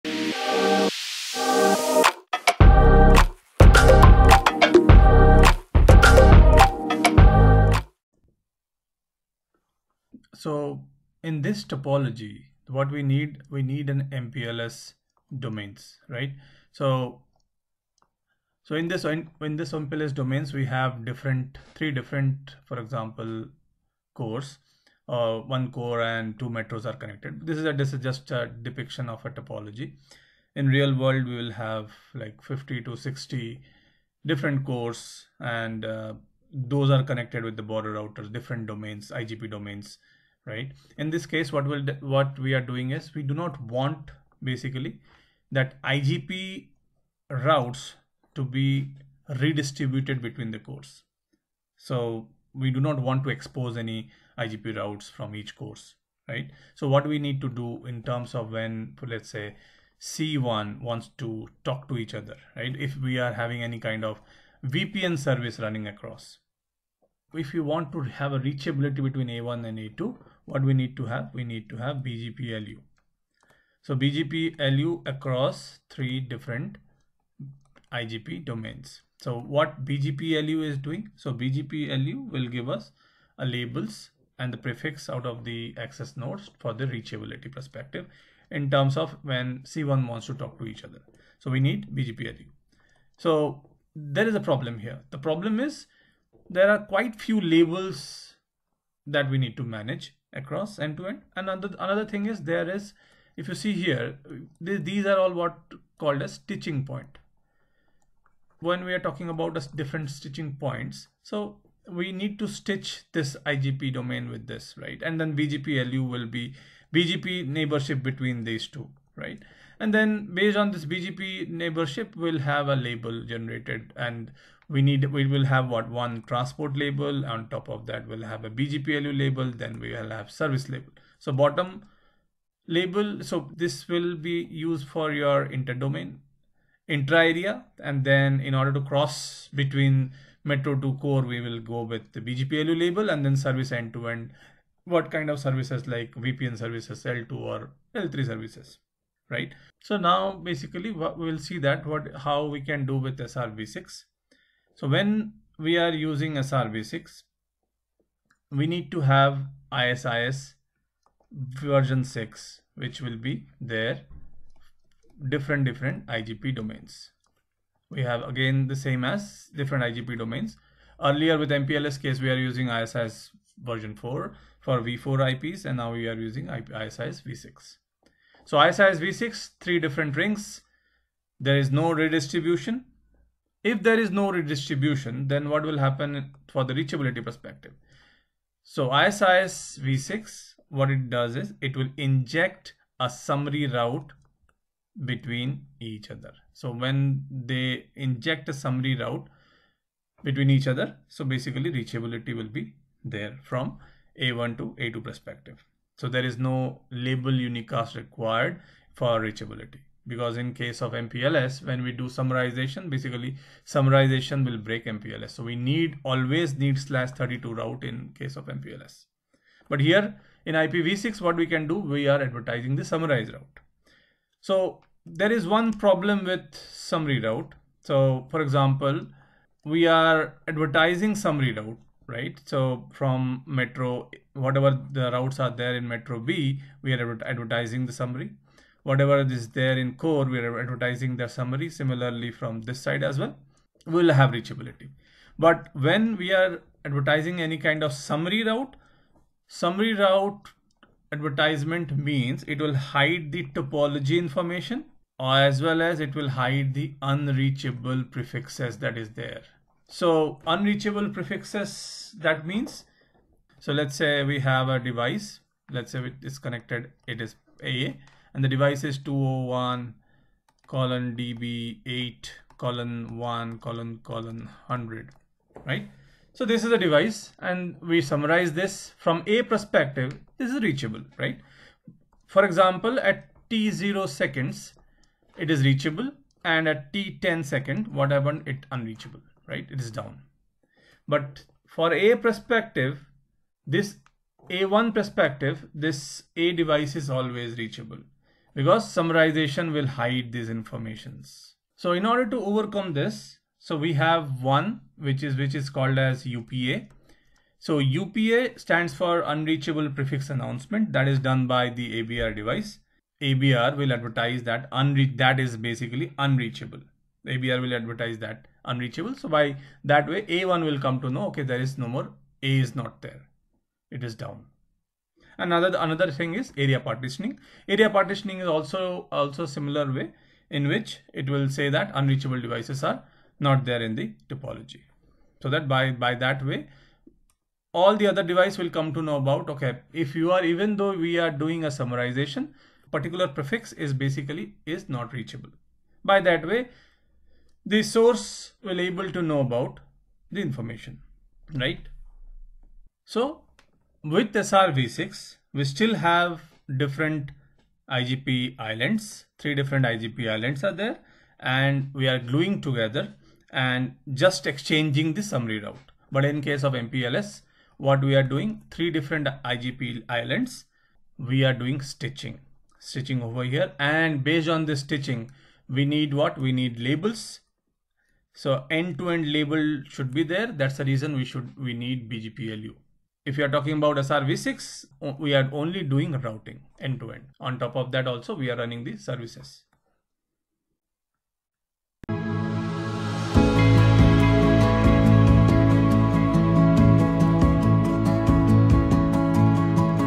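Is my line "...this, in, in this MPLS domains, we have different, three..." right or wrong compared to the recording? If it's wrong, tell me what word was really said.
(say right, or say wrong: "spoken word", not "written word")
right.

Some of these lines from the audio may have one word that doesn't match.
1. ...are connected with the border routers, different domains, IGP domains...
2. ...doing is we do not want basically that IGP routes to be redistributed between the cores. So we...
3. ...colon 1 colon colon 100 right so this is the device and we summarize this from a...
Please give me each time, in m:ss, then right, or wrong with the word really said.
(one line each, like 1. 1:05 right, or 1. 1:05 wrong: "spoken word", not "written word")
1. 0:36 right
2. 0:42 right
3. 4:32 right.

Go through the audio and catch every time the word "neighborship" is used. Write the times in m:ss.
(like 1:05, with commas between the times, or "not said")
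1:57, 2:01.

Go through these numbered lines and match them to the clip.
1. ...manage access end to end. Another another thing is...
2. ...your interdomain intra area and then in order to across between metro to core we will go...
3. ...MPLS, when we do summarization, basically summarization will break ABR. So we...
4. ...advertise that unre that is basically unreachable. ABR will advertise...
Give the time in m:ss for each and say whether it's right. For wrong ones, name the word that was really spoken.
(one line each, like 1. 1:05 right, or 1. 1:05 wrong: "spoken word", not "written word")
1. 1:39 wrong: "across", not "access"
2. 2:15 wrong: "cross", not "across"
3. 3:30 wrong: "MPLS", not "ABR"
4. 5:13 right.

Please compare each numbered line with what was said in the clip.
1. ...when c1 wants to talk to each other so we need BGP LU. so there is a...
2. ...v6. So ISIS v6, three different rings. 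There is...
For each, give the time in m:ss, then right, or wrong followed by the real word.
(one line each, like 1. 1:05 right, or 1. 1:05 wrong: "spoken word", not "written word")
1. 1:29 right
2. 2:57 right.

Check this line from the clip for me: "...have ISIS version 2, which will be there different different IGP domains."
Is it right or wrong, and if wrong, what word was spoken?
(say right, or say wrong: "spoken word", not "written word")
wrong: "6", not "2".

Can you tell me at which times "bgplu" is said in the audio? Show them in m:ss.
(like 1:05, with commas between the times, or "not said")
2:08, 2:22, 6:22.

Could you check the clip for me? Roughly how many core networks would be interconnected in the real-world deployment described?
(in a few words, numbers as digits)
50 to 60.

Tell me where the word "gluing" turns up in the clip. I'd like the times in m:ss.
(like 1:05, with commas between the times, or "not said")
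6:02.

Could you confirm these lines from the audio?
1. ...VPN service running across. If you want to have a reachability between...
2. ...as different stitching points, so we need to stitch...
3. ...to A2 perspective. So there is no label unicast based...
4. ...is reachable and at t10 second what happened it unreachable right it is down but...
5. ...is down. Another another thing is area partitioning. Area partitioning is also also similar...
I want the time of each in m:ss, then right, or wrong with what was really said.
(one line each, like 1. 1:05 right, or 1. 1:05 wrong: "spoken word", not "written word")
1. 1:04 right
2. 1:49 right
3. 3:24 wrong: "required", not "based"
4. 4:45 right
5. 5:24 right.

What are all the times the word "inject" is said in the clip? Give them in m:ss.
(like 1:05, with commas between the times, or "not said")
3:11, 3:17.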